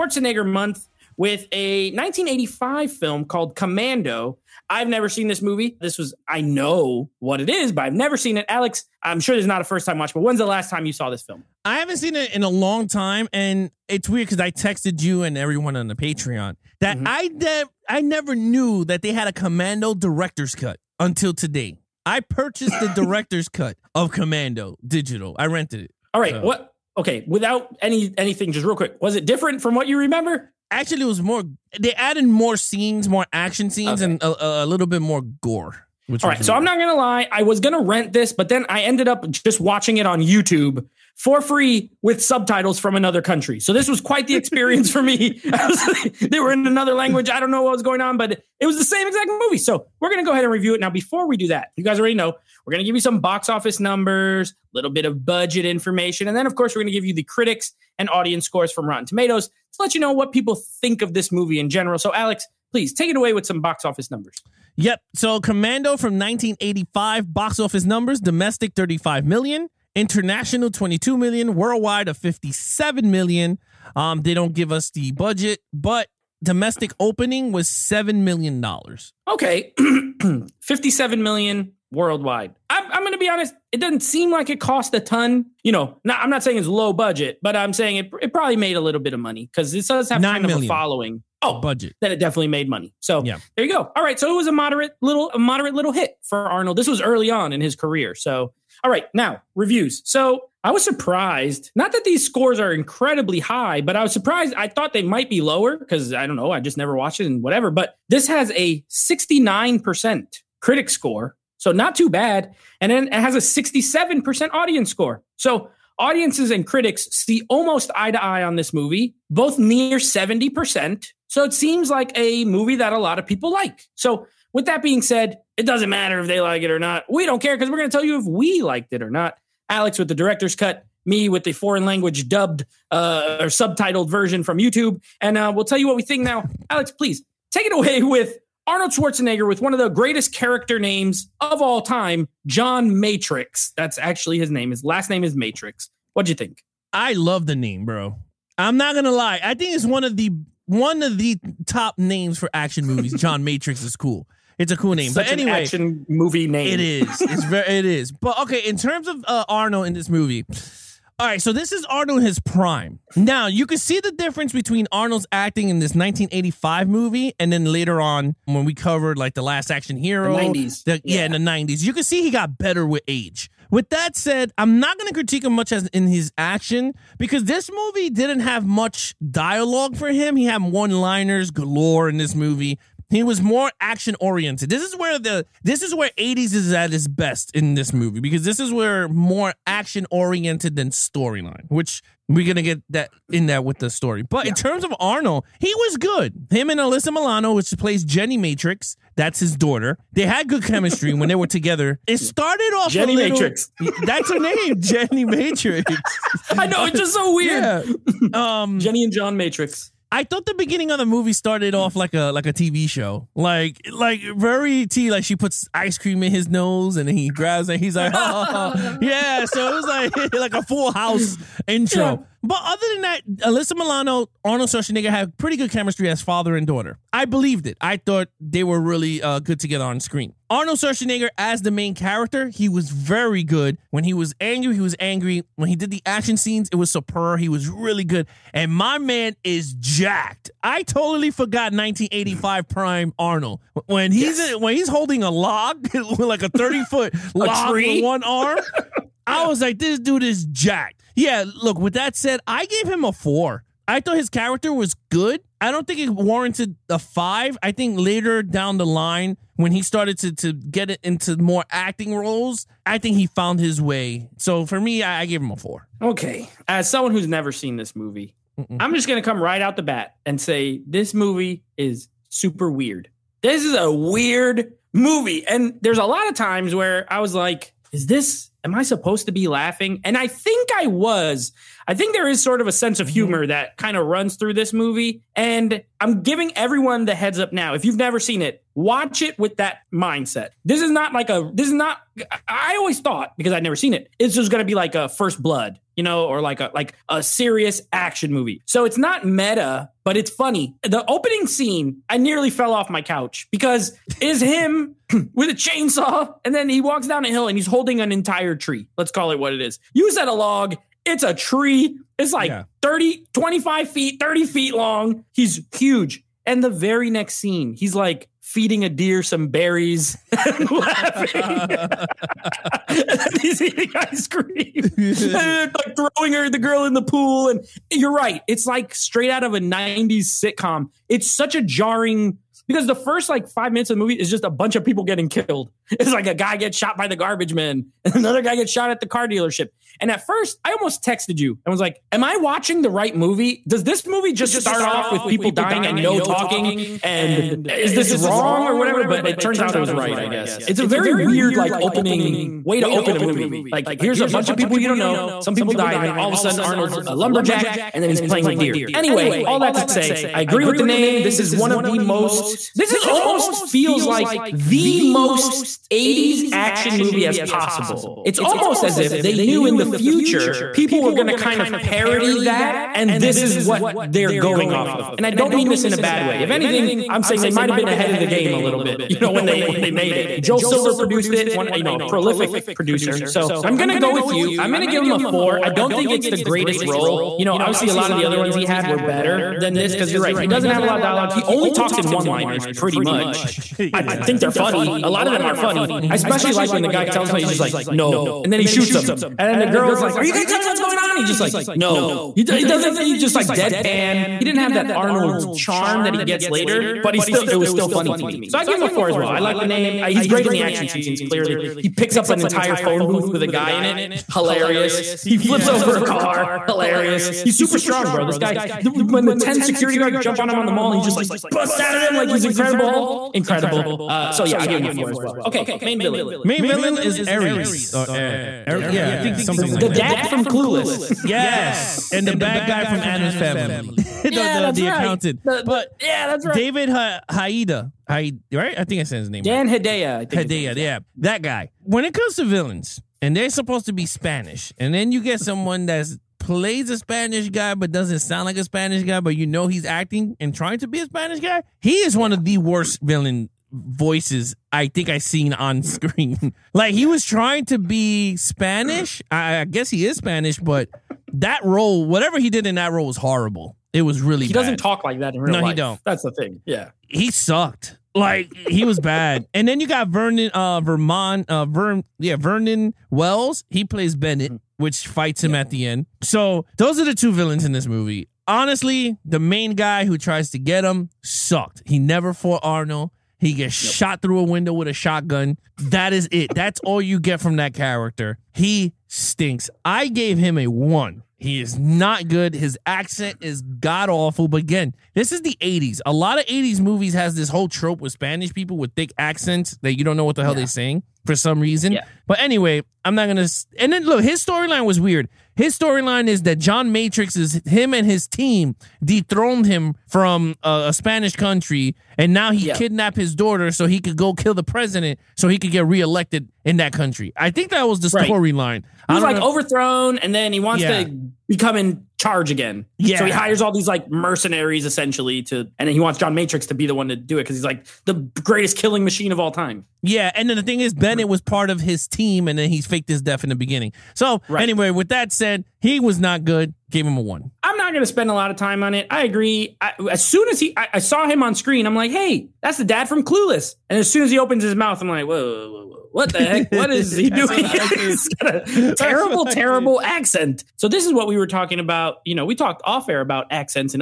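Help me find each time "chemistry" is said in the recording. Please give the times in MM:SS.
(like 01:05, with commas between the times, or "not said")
03:20, 03:45.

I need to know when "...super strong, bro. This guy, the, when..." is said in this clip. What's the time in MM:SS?
06:57.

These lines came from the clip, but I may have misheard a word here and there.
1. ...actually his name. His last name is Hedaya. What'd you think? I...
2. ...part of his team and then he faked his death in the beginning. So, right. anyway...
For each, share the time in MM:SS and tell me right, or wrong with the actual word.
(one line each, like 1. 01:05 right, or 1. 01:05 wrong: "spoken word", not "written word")
1. 02:23 wrong: "Matrix", not "Hedaya"
2. 08:51 right.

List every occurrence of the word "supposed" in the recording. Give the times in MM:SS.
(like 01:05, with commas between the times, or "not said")
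04:38, 07:23.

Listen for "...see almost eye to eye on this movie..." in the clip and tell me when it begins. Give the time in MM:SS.
01:57.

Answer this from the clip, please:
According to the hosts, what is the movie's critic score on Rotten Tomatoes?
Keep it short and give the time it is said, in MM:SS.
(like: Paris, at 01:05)
69%, at 01:48.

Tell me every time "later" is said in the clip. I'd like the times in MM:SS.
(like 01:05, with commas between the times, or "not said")
02:47, 04:17, 06:46.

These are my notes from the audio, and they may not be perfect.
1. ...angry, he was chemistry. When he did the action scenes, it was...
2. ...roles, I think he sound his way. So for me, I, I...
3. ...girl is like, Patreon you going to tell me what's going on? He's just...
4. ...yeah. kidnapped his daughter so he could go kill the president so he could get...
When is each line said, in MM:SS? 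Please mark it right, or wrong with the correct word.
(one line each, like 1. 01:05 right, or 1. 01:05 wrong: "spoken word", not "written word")
1. 03:54 wrong: "angry", not "chemistry"
2. 04:22 wrong: "found", not "sound"
3. 06:39 wrong: "Are", not "Patreon"
4. 08:32 right.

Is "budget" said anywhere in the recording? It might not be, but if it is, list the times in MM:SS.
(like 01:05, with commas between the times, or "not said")
00:55, 01:15, 01:26, 01:31.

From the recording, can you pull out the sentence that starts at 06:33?
i think they're funny a lot of them are funny mm-hmm.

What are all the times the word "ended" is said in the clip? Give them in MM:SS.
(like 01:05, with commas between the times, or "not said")
00:38.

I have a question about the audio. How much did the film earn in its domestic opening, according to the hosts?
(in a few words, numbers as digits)
7 million dollars.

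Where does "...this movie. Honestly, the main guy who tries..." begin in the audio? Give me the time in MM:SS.
07:57.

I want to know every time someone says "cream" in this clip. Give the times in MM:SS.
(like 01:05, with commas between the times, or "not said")
03:35, 05:24.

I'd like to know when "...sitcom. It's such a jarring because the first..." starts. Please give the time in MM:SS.
05:30.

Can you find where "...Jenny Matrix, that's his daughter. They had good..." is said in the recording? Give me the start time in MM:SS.
03:18.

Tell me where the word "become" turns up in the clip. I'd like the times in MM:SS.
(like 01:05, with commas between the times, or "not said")
08:41.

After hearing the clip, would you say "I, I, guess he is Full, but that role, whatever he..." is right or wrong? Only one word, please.
wrong.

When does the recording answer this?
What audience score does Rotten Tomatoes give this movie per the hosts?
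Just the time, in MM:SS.
01:53.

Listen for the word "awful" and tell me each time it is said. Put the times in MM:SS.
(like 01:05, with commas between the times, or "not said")
08:14.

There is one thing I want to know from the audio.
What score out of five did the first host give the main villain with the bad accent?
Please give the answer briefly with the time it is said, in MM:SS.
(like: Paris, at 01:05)
1, at 08:09.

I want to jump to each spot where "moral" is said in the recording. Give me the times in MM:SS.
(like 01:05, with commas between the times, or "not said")
not said.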